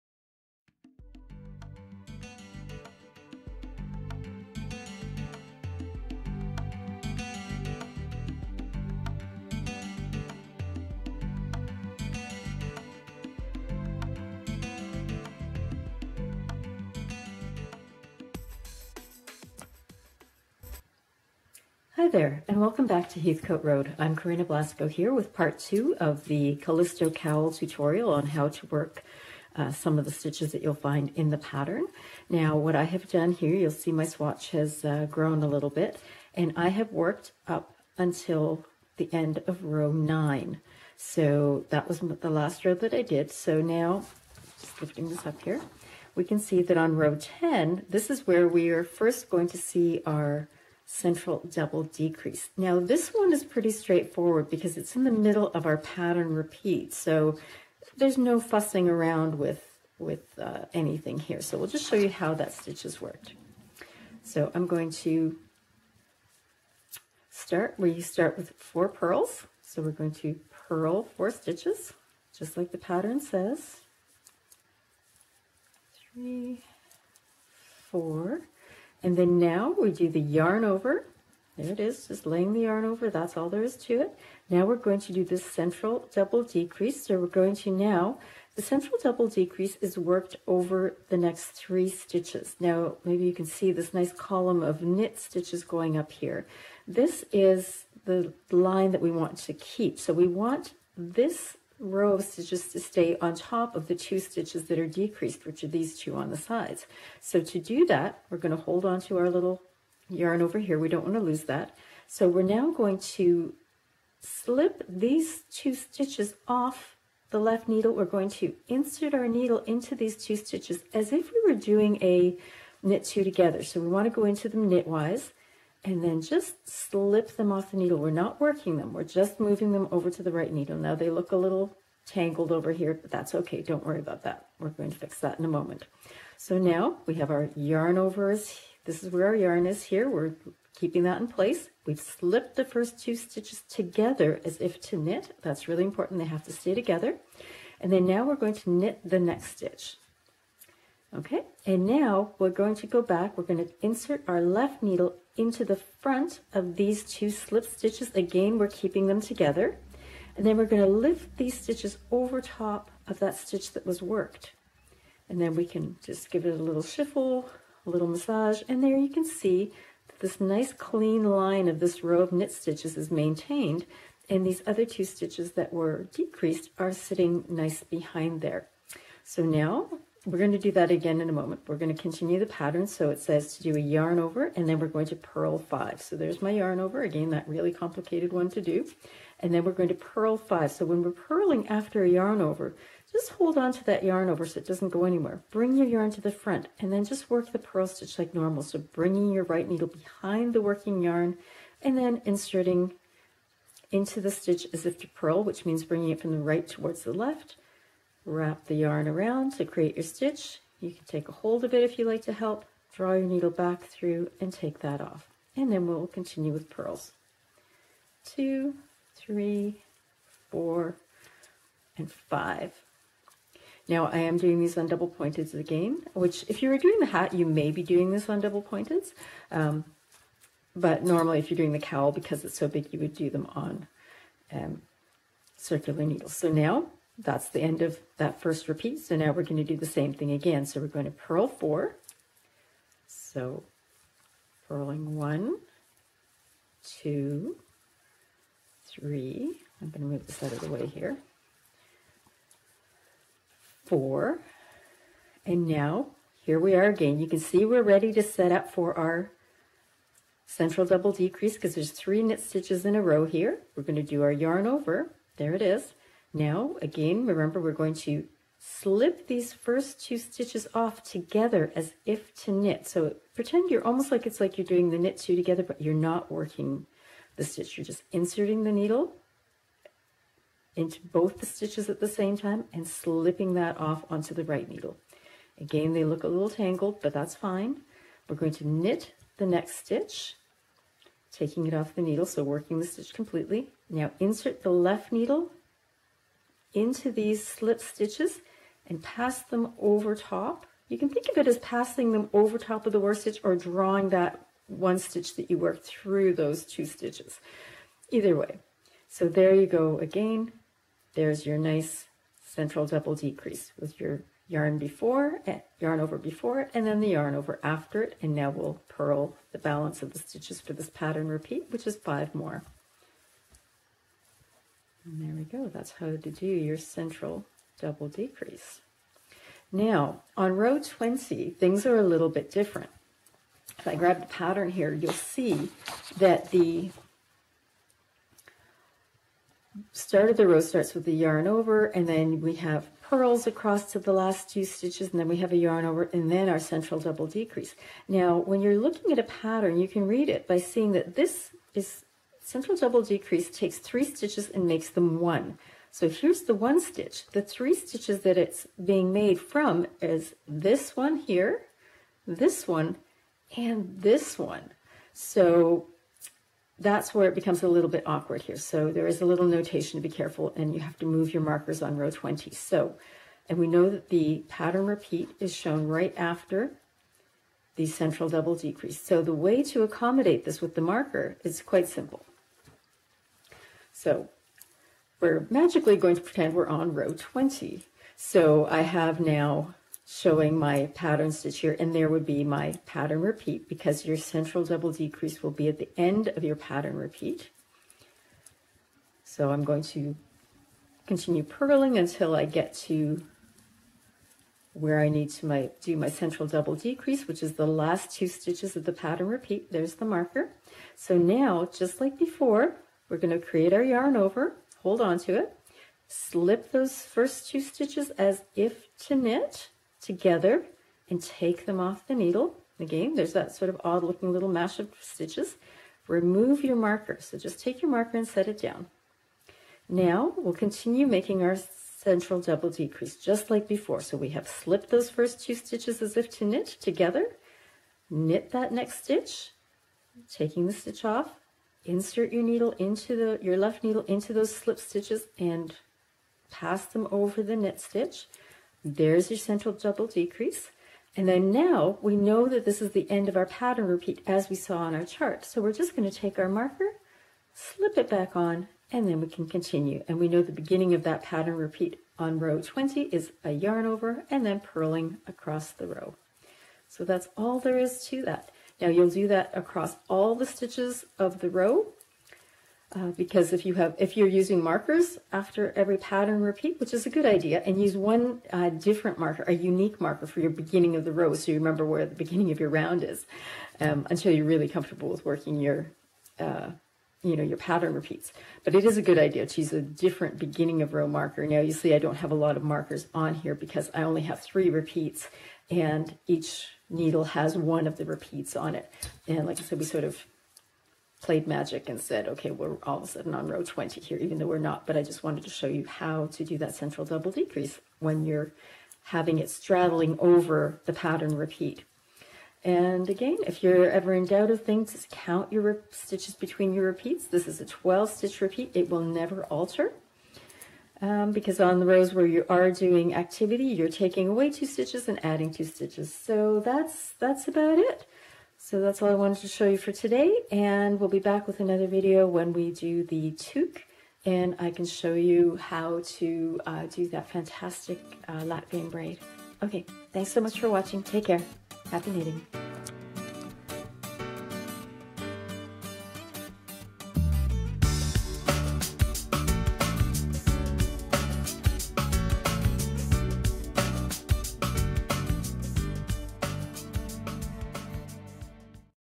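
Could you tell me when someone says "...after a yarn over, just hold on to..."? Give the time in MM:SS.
03:11.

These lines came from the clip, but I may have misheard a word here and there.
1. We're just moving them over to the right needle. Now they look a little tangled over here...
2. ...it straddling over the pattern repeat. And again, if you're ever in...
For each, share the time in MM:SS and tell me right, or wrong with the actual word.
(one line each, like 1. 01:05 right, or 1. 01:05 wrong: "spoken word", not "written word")
1. 02:08 right
2. 08:29 right.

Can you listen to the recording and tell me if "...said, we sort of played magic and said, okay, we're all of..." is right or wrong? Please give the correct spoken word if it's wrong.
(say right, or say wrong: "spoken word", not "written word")
right.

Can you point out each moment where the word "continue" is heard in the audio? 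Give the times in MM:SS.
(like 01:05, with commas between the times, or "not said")
03:01, 03:36, 06:41, 07:10, 07:39.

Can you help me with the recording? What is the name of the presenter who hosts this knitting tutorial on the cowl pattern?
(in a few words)
Coryna Blasko.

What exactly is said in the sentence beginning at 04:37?
You're just inserting the needle into both the stitches at the same time and slipping that off onto the right needle.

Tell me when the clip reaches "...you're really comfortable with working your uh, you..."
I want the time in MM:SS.
08:04.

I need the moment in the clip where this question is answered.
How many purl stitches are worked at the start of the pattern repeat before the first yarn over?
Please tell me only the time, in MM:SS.
01:08.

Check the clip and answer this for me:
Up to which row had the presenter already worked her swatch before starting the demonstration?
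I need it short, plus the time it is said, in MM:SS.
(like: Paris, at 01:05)
9, at 00:39.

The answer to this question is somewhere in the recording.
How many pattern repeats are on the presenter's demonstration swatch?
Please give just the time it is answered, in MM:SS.
08:14.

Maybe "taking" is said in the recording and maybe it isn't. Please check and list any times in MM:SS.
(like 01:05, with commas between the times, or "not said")
04:51, 07:20, 08:43.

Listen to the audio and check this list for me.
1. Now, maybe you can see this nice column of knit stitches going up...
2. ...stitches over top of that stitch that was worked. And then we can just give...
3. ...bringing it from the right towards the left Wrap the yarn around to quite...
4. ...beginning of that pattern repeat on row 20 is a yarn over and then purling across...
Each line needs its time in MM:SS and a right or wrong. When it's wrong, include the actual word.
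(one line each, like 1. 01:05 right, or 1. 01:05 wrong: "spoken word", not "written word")
1. 01:32 right
2. 02:41 right
3. 03:25 wrong: "create", not "quite"
4. 07:40 right.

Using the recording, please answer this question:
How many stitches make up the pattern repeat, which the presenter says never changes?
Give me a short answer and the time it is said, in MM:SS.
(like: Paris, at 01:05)
12, at 08:37.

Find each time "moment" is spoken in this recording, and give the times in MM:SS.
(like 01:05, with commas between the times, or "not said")
02:15, 03:01.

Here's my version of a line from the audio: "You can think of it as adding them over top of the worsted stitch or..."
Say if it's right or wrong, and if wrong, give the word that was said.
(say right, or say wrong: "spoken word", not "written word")
wrong: "passing", not "adding".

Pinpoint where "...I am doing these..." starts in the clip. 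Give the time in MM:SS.
03:44.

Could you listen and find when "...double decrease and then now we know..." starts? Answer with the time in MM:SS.
07:29.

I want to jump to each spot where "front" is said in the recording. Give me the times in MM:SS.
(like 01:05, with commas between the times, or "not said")
02:35, 03:16.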